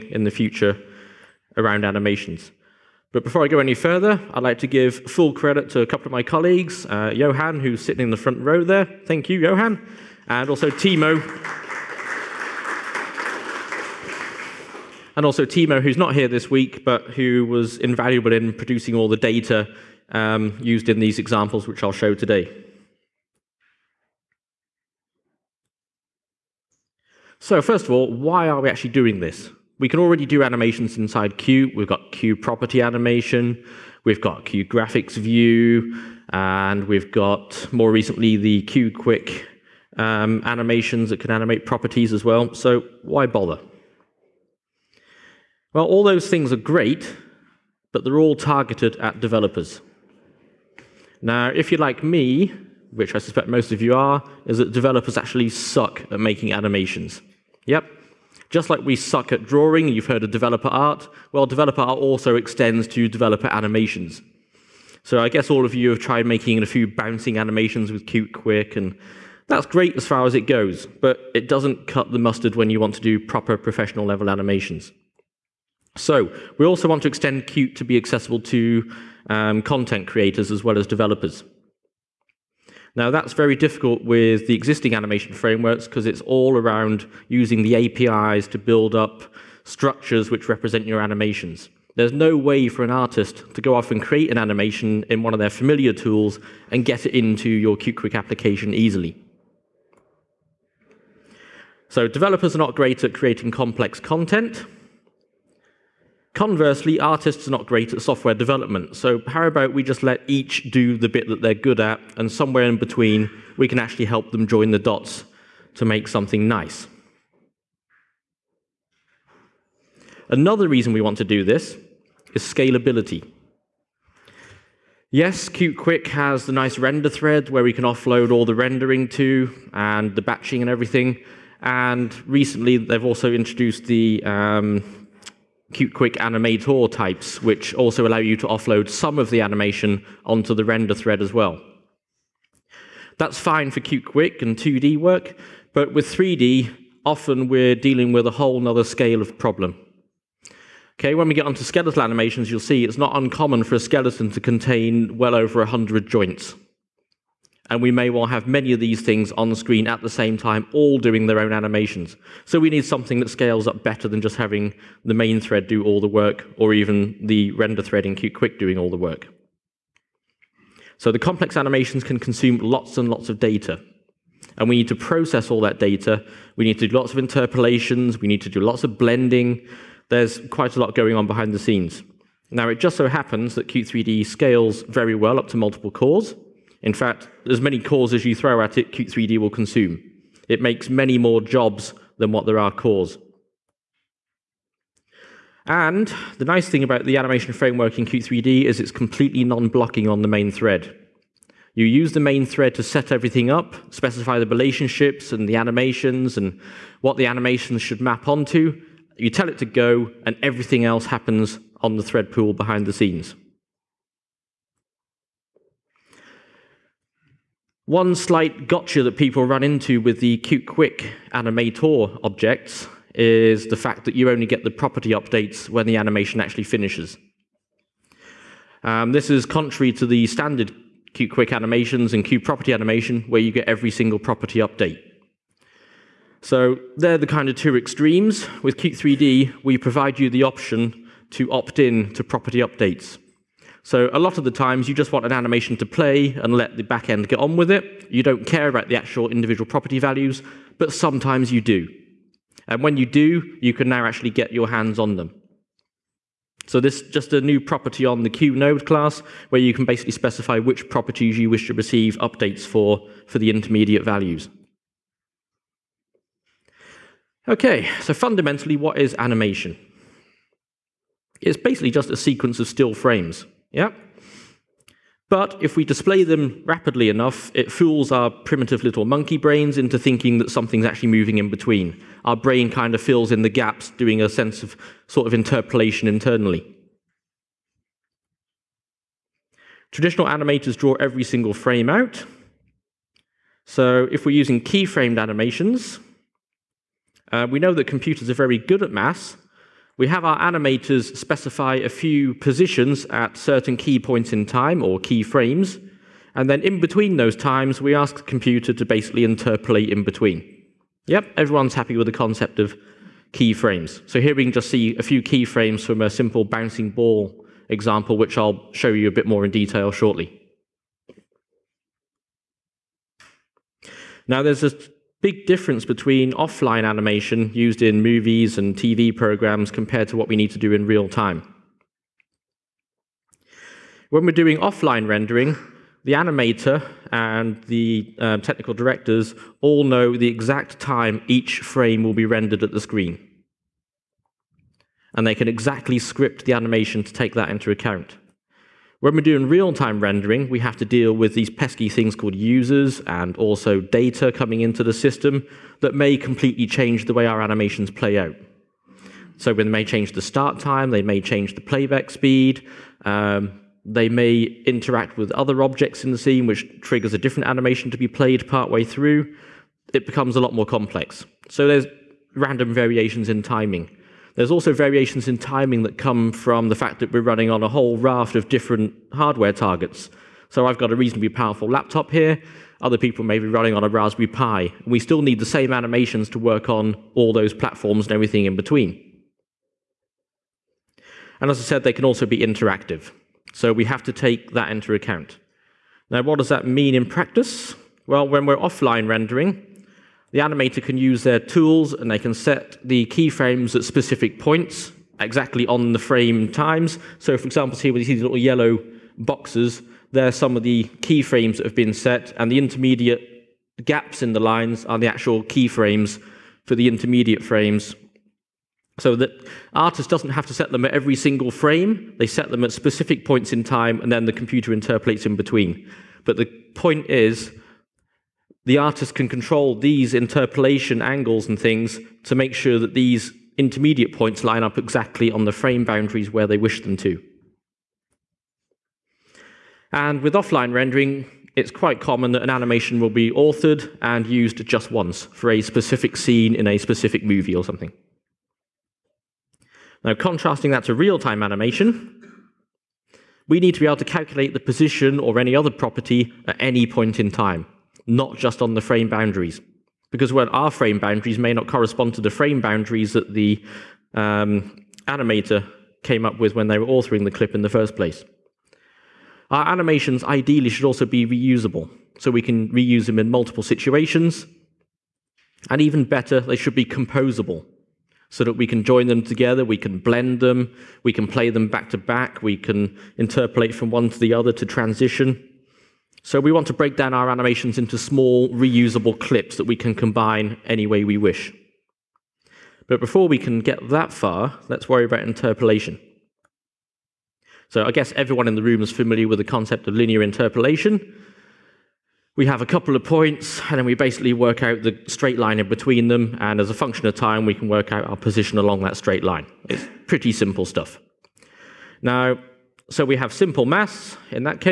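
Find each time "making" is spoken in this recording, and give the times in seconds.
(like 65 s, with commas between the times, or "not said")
56 s, 66 s.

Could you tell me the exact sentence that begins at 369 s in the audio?
It becomes a lot more complex.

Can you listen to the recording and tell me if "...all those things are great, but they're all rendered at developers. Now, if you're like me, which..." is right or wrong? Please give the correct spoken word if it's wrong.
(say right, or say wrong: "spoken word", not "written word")
wrong: "targeted", not "rendered".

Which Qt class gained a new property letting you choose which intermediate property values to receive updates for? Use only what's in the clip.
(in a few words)
QNode.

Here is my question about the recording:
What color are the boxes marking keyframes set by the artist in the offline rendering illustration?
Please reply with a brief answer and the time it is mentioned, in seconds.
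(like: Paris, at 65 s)
yellow, at 408 s.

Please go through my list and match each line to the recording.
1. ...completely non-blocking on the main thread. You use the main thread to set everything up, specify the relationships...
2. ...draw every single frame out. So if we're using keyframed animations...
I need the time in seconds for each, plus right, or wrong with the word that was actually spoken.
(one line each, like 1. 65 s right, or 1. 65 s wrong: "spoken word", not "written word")
1. 198 s right
2. 290 s right.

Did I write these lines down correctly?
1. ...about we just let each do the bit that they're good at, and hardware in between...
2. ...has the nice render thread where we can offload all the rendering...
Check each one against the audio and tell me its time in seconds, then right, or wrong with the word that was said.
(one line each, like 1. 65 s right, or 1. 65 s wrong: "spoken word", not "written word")
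1. 109 s wrong: "somewhere", not "hardware"
2. 126 s right.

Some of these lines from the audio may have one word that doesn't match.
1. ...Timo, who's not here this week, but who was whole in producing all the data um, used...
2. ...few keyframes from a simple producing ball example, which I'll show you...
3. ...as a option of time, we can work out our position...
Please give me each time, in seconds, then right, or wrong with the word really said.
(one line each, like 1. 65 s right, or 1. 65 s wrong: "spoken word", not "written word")
1. 15 s wrong: "invaluable", not "whole"
2. 315 s wrong: "bouncing", not "producing"
3. 506 s wrong: "function", not "option".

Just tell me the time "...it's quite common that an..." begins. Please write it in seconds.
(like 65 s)
441 s.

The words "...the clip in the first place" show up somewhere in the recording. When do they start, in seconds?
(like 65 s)
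467 s.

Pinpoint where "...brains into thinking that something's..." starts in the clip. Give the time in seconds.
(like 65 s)
279 s.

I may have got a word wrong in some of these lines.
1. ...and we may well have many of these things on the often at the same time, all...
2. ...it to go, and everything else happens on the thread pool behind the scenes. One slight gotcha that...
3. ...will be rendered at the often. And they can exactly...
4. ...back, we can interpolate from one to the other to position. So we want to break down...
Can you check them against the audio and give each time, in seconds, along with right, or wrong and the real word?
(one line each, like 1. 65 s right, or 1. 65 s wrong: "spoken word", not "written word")
1. 157 s wrong: "screen", not "often"
2. 209 s right
3. 342 s wrong: "screen", not "often"
4. 481 s wrong: "transition", not "position".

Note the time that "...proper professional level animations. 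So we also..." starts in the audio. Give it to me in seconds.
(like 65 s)
73 s.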